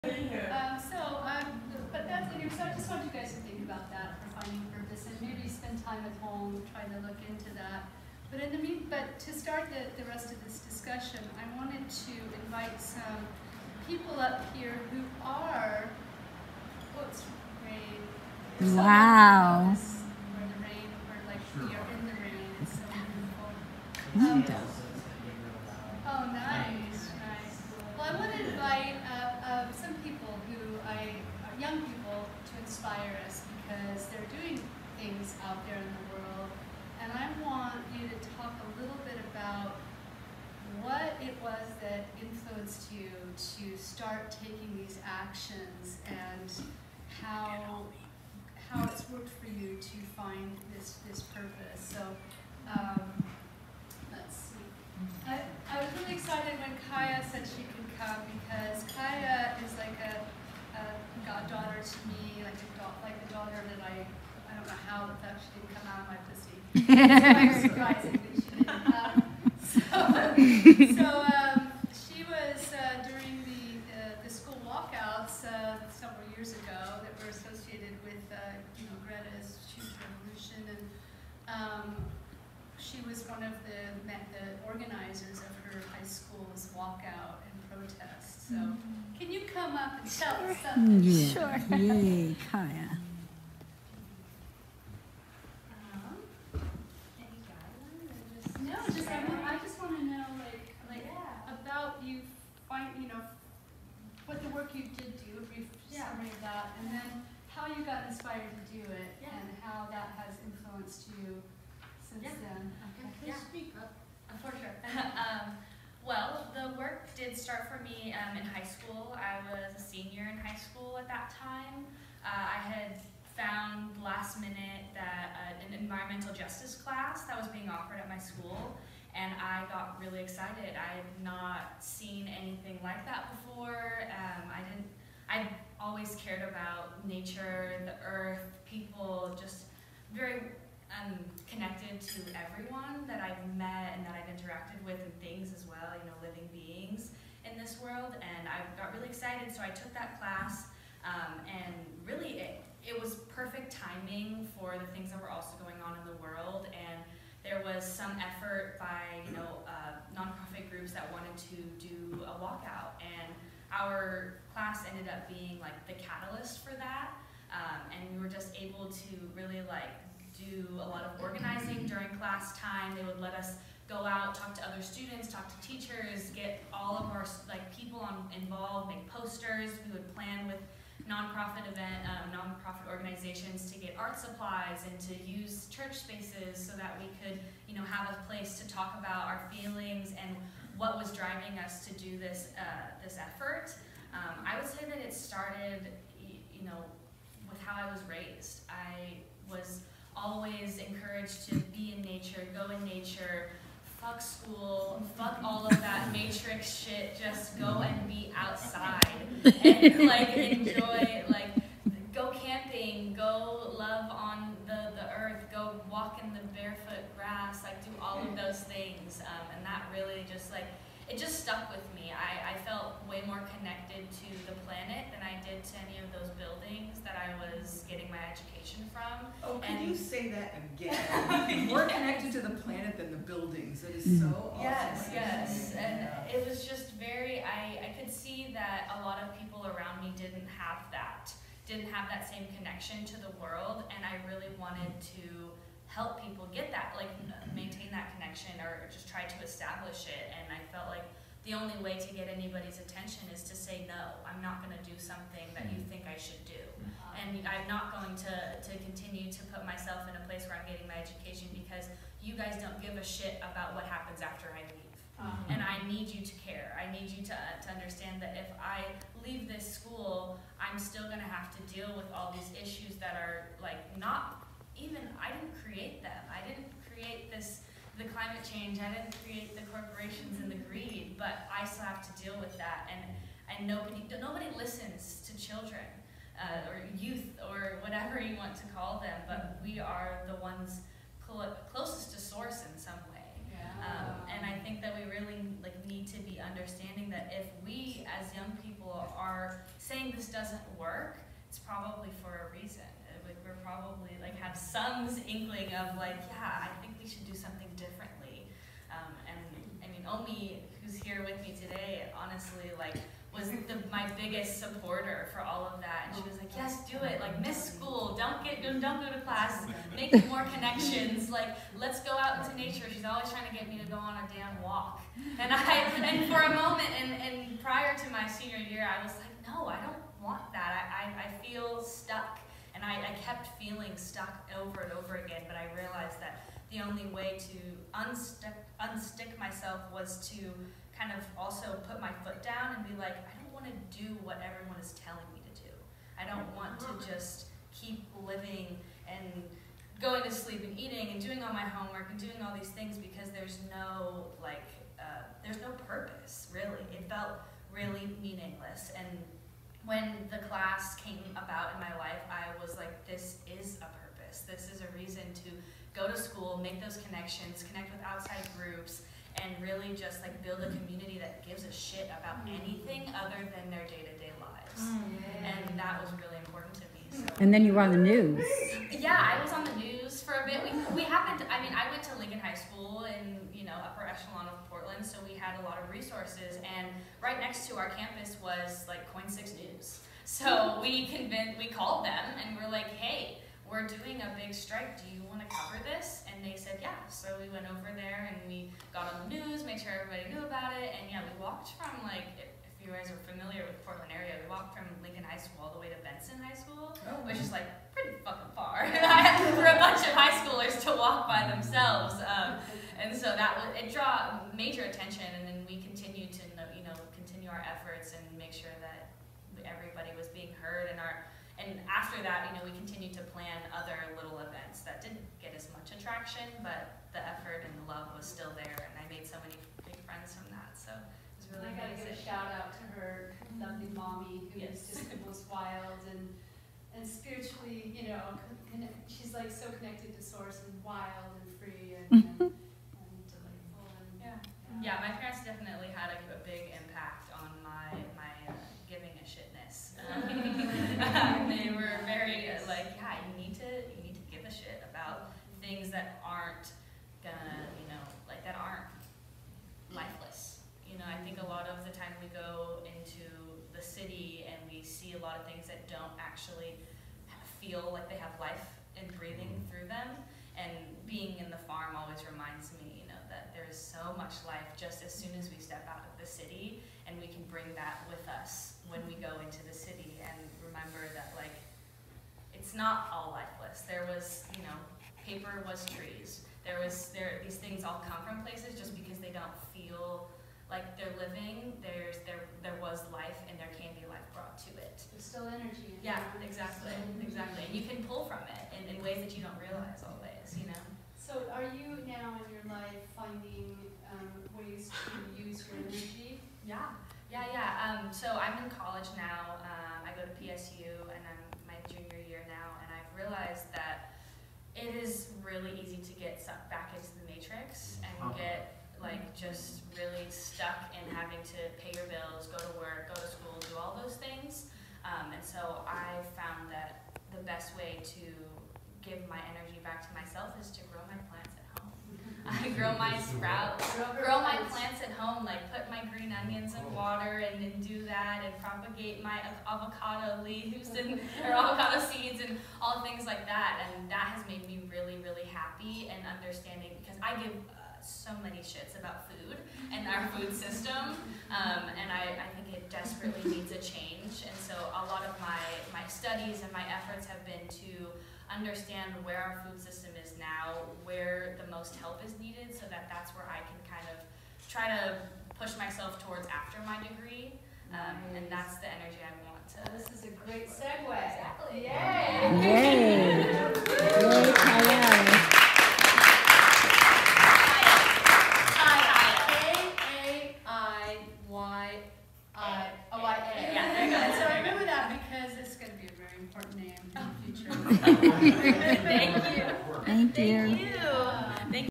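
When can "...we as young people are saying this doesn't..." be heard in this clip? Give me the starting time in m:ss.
4:57.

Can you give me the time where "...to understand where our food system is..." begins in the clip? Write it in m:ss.
9:17.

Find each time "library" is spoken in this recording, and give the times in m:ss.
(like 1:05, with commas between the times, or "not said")
not said.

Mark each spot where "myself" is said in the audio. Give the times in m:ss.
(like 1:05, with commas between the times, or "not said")
4:19, 5:39, 8:50, 9:25.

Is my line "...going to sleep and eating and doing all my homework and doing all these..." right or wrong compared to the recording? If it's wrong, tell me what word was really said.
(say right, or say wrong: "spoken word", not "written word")
right.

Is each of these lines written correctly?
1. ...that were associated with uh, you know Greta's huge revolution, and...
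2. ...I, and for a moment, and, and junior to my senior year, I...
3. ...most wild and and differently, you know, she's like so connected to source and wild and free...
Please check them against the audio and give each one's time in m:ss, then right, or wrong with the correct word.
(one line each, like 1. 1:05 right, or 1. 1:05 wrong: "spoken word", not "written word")
1. 1:17 right
2. 5:25 wrong: "prior", not "junior"
3. 7:15 wrong: "spiritually", not "differently".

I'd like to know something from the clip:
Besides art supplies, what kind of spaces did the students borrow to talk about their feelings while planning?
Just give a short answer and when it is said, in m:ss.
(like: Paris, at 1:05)
Church spaces, at 3:05.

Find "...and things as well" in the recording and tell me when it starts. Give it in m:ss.
2:25.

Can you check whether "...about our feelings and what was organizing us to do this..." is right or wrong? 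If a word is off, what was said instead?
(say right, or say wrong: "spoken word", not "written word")
wrong: "driving", not "organizing".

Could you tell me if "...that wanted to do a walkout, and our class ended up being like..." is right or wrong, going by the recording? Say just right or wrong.
right.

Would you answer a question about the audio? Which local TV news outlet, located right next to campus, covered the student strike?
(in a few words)
KOIN Six News.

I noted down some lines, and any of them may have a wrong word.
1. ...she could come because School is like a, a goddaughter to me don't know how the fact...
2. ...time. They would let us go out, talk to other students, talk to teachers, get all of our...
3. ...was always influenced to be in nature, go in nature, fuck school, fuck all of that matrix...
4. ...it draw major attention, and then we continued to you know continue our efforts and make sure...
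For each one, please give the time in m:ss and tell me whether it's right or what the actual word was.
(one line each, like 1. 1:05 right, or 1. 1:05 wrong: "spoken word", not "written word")
1. 0:57 wrong: "Kaiya", not "School"
2. 2:52 right
3. 3:19 wrong: "encouraged", not "influenced"
4. 6:53 right.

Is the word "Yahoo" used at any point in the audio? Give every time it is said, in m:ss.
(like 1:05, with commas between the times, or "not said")
not said.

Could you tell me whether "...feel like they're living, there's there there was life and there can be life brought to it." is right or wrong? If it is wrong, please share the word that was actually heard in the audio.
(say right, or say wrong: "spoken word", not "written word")
right.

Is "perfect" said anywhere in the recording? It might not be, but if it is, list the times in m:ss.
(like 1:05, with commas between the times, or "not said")
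2:33.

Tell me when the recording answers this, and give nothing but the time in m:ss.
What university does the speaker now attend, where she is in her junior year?
8:30.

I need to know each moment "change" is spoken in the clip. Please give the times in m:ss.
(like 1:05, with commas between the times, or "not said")
4:38, 9:13.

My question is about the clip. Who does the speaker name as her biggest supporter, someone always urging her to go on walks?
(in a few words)
Omi.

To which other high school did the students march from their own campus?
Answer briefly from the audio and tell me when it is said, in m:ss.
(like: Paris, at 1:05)
Benson High School, at 6:45.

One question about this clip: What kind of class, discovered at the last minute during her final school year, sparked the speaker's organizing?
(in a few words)
Environmental justice.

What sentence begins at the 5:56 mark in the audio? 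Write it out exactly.
It felt really meaningless and when the class came about in my life, I was like, this is a purpose.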